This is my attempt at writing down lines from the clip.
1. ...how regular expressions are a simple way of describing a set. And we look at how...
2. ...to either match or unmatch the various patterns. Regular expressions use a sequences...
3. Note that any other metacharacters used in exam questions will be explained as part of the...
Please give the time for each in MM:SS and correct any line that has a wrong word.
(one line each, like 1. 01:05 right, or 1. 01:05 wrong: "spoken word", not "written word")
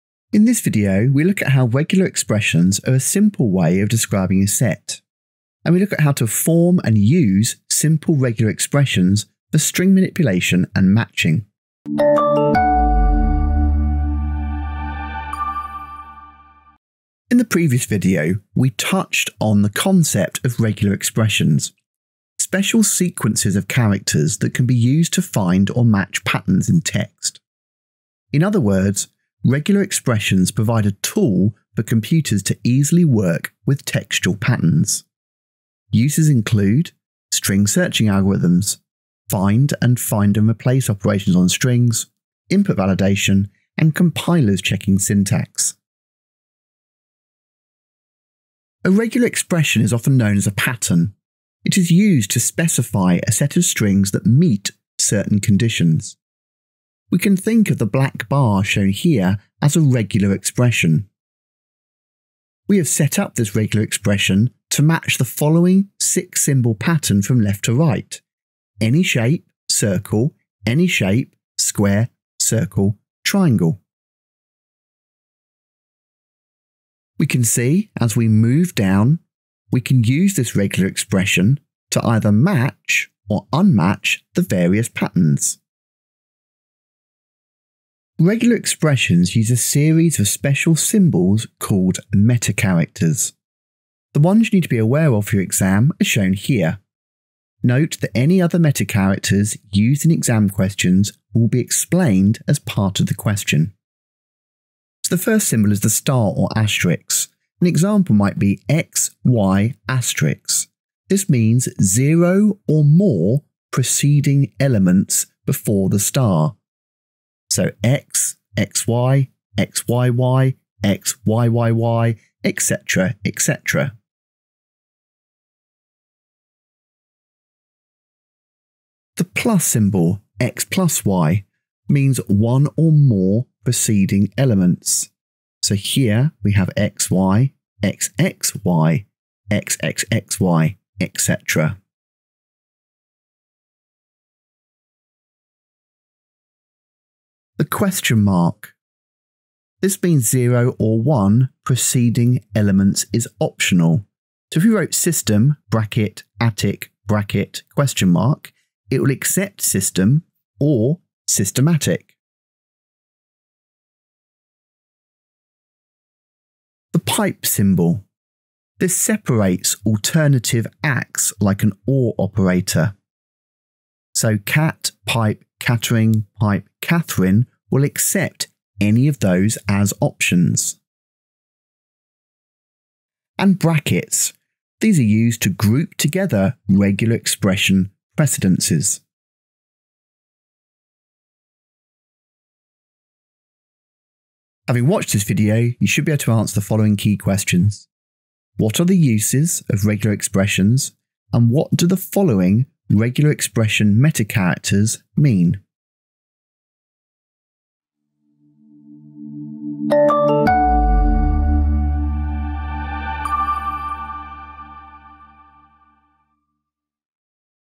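1. 00:01 right
2. 01:21 wrong: "series", not "sequences"
3. 01:37 right.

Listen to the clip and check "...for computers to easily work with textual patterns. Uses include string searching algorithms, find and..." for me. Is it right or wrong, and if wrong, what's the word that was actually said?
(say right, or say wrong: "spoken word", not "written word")
right.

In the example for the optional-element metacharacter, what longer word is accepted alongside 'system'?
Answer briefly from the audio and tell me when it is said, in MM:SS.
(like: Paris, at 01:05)
systematic, at 02:41.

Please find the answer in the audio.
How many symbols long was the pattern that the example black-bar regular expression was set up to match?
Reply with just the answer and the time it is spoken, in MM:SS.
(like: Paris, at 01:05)
6, at 01:05.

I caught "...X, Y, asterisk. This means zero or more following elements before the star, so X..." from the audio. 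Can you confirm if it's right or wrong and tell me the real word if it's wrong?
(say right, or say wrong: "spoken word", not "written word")
wrong: "preceding", not "following".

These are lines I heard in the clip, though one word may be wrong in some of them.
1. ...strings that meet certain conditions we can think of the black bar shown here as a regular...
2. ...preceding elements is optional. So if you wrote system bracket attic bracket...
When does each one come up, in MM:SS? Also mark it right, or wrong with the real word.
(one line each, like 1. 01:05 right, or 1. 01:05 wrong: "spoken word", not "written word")
1. 00:53 right
2. 02:31 right.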